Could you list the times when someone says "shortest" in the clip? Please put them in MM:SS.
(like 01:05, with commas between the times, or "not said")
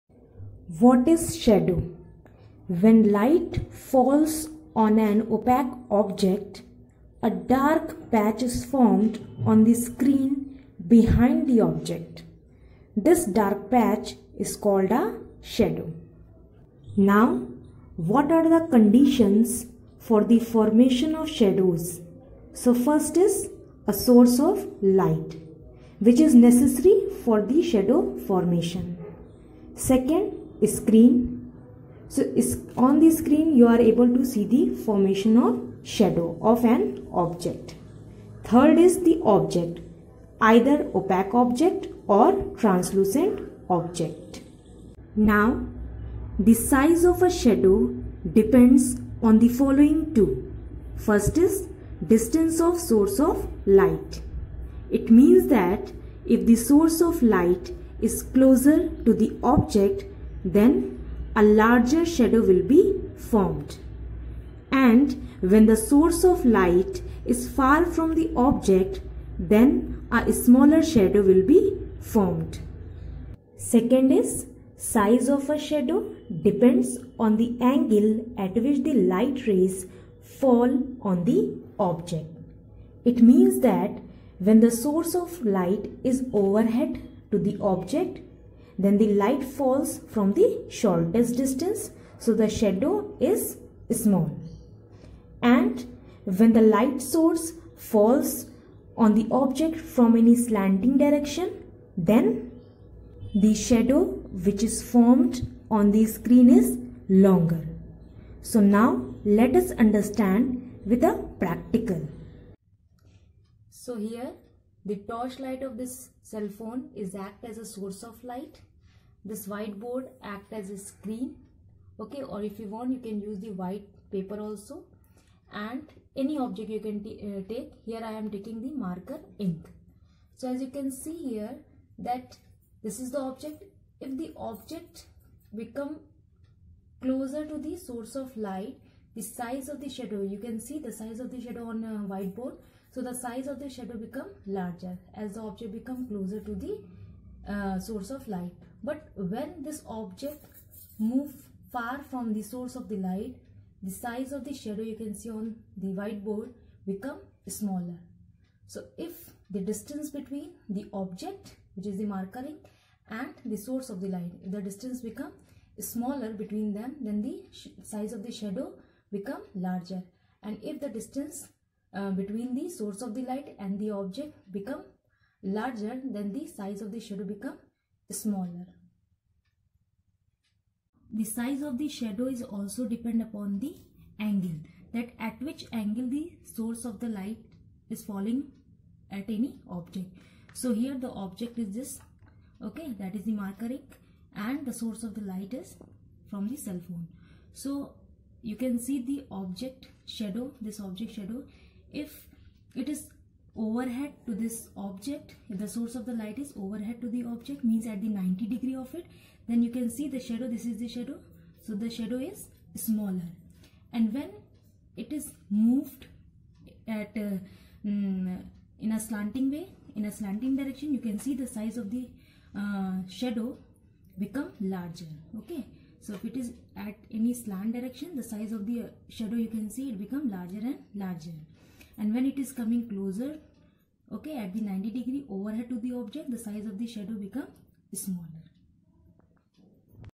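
01:30.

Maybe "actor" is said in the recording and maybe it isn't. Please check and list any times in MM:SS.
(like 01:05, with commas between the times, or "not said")
not said.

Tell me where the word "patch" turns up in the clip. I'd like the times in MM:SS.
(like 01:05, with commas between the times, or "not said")
00:08, 00:13.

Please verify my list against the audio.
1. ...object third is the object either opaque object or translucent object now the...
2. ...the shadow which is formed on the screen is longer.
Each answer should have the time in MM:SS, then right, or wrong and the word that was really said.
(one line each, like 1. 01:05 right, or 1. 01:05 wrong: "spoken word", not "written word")
1. 00:37 right
2. 01:43 right.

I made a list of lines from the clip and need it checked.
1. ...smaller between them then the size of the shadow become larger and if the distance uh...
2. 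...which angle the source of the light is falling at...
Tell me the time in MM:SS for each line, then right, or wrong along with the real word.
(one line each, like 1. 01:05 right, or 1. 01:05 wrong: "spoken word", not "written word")
1. 02:45 right
2. 03:05 right.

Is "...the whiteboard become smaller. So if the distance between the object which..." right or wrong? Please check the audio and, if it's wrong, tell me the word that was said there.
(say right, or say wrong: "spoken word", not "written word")
right.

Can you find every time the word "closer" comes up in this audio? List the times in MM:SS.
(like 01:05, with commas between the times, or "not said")
00:58, 02:17, 02:26, 03:52.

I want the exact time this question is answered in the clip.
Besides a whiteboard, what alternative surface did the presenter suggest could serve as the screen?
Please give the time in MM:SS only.
02:03.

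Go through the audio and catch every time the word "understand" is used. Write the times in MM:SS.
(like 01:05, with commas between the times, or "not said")
01:49.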